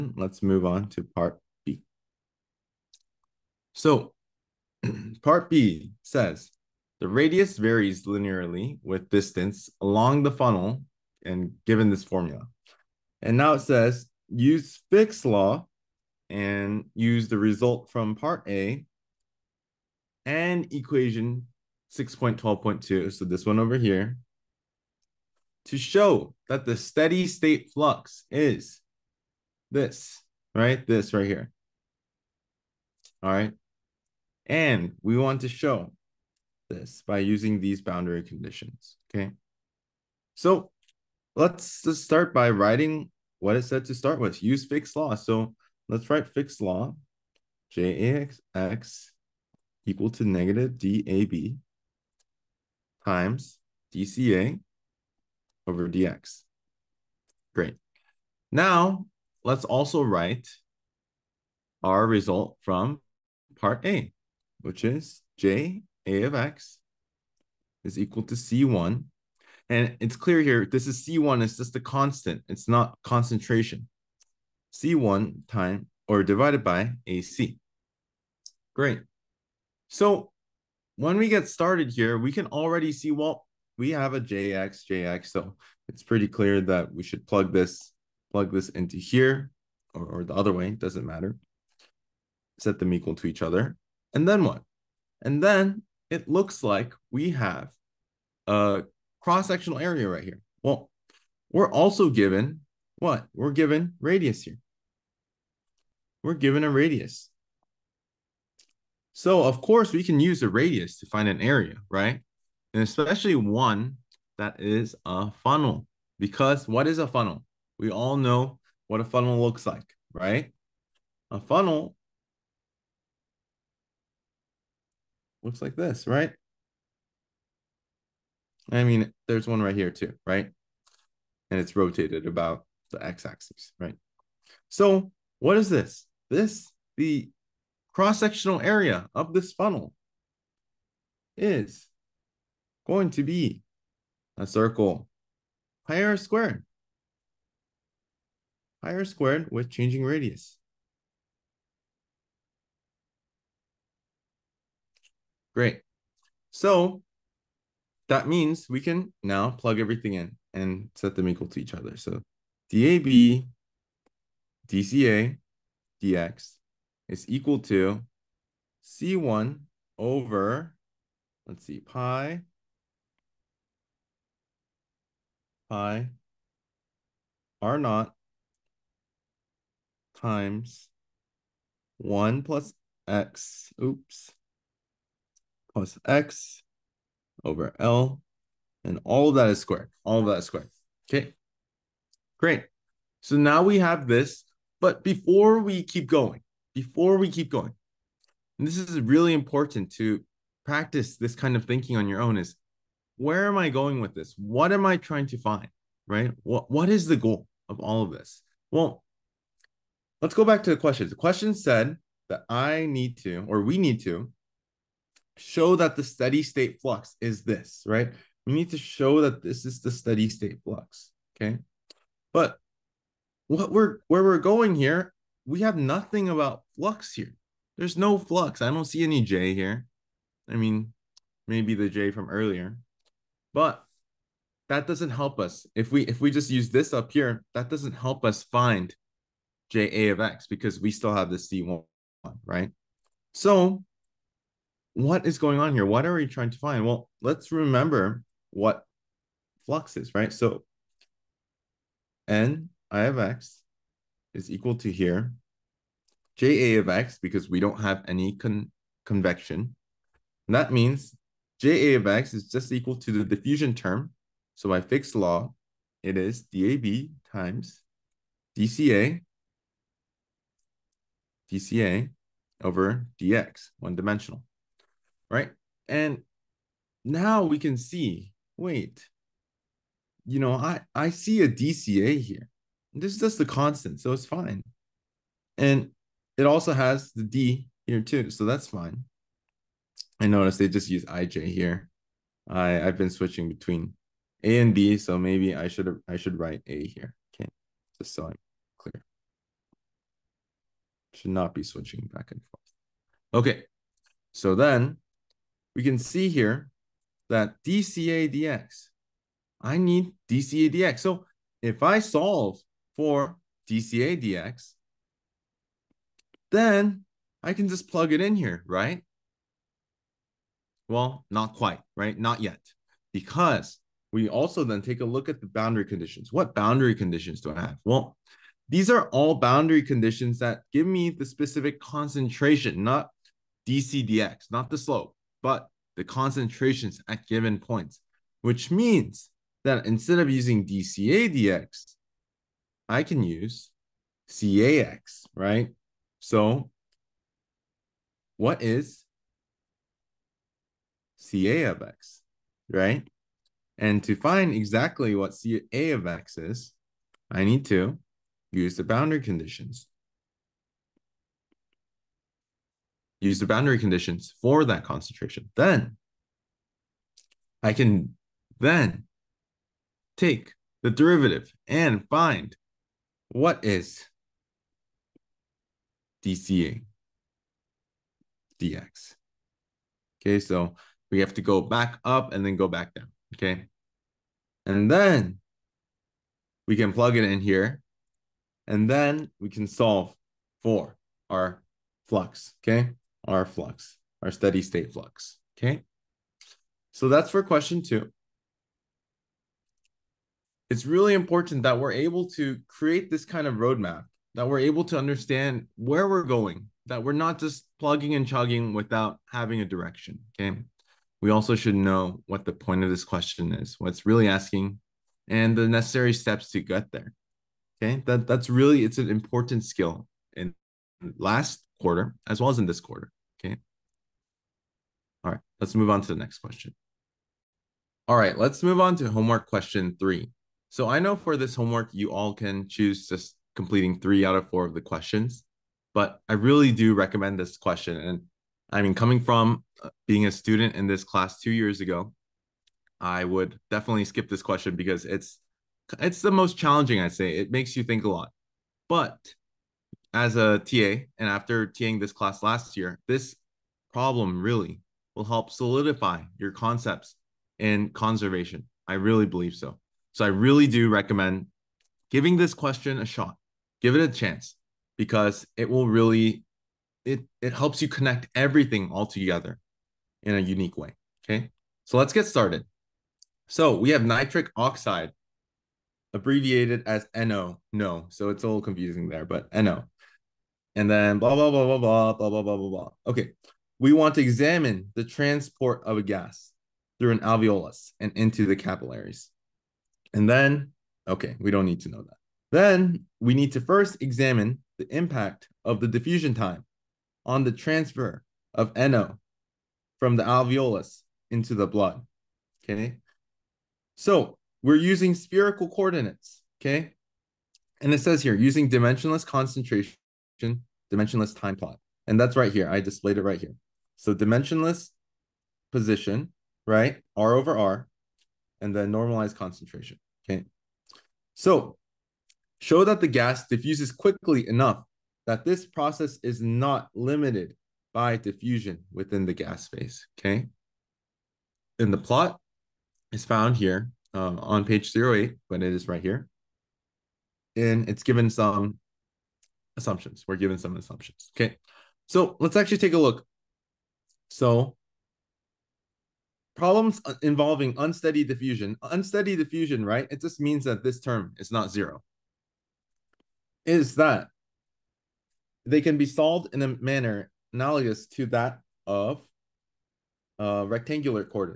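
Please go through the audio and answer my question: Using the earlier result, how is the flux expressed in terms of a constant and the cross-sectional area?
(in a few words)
C1 divided by AC.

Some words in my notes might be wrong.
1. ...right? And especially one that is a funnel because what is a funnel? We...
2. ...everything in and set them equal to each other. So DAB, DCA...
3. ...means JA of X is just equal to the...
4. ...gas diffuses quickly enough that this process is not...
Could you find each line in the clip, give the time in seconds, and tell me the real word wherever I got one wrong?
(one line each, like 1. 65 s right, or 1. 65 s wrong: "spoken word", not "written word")
1. 111 s right
2. 159 s right
3. 260 s right
4. 523 s right.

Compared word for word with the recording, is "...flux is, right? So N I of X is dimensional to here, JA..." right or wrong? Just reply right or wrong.
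wrong.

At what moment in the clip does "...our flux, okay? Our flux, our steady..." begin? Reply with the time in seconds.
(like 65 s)
391 s.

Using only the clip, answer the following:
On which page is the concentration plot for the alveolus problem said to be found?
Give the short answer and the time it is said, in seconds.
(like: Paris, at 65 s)
08, at 534 s.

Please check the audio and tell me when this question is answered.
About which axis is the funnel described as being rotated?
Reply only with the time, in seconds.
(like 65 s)
133 s.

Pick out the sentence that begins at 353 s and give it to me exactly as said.
And to find exactly what CA of X is, I need to use the boundary conditions.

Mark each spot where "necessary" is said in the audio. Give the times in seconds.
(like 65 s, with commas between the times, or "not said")
415 s.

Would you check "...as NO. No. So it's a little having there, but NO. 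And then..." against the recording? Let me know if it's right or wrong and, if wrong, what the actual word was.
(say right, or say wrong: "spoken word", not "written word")
wrong: "confusing", not "having".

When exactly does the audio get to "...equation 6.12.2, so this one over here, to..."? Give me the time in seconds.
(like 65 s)
20 s.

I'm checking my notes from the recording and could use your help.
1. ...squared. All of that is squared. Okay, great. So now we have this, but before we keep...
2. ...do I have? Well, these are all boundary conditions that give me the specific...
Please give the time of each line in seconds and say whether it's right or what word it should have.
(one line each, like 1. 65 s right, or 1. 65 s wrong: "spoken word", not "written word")
1. 189 s right
2. 327 s right.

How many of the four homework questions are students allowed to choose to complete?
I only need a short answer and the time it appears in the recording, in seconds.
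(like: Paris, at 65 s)
3, at 433 s.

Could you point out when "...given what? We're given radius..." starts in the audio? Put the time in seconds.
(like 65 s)
102 s.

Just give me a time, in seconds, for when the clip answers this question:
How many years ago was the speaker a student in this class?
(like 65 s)
441 s.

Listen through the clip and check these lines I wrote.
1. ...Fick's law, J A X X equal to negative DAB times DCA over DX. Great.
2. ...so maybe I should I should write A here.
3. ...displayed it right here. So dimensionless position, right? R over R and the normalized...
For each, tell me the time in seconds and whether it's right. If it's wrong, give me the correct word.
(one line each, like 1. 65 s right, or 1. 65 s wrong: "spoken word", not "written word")
1. 46 s right
2. 294 s right
3. 512 s right.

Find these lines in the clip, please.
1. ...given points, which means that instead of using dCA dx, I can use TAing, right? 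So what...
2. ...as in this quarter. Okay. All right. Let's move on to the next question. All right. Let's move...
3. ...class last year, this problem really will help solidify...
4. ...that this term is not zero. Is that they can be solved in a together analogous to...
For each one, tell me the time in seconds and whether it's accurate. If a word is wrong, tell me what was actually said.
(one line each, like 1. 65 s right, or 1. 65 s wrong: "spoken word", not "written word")
1. 337 s wrong: "CAX", not "TAing"
2. 422 s right
3. 452 s right
4. 550 s wrong: "manner", not "together".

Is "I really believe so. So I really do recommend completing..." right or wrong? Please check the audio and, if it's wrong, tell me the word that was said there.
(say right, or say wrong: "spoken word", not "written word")
wrong: "giving", not "completing".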